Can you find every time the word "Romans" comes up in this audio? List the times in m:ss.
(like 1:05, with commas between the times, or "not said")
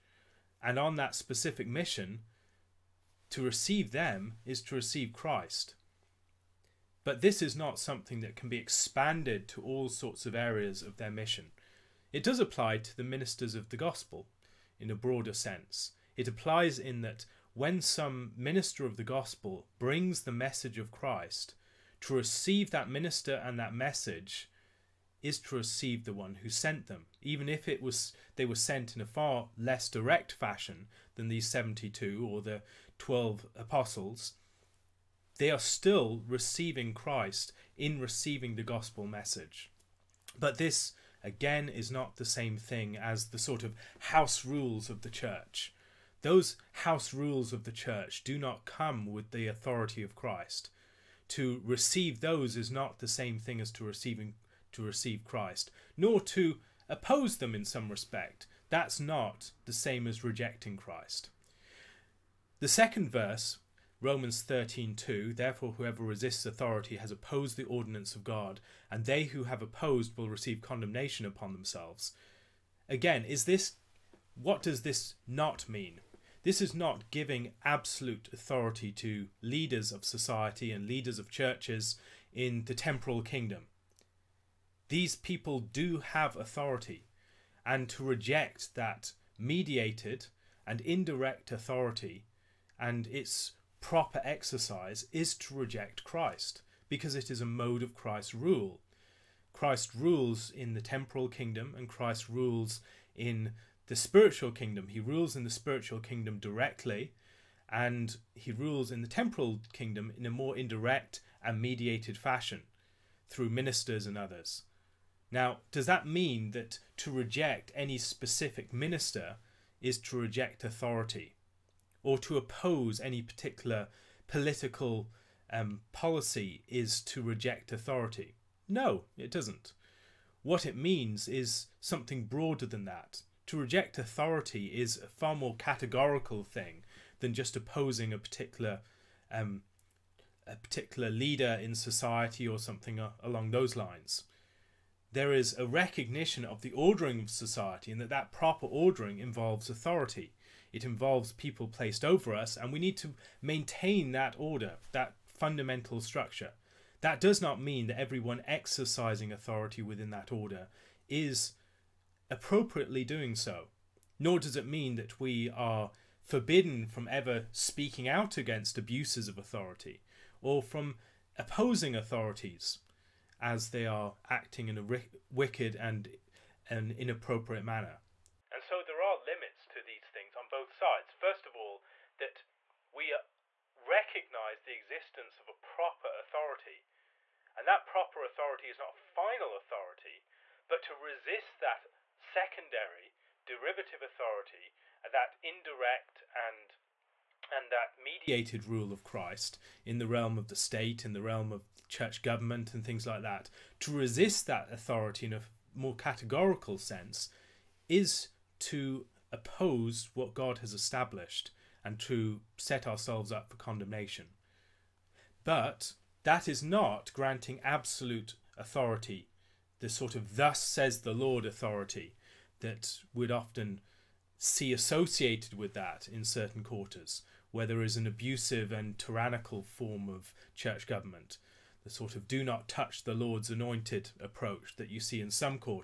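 1:04.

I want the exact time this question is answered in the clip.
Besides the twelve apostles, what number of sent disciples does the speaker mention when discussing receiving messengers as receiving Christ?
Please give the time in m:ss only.
0:31.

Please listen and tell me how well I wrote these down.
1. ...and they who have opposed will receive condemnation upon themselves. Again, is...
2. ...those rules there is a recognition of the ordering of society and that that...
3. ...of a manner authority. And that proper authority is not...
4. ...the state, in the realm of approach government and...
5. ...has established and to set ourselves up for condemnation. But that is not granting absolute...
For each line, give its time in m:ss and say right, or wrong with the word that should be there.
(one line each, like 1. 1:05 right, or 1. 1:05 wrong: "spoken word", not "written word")
1. 1:08 right
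2. 2:23 wrong: "lines", not "rules"
3. 3:05 wrong: "proper", not "manner"
4. 3:20 wrong: "church", not "approach"
5. 3:30 right.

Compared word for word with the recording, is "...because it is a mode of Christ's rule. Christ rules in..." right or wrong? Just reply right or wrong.
right.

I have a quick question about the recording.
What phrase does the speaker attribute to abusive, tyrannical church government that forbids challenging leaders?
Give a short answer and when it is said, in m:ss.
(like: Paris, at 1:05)
do not touch the Lord's anointed, at 3:52.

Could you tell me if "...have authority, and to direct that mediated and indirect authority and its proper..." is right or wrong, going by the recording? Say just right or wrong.
wrong.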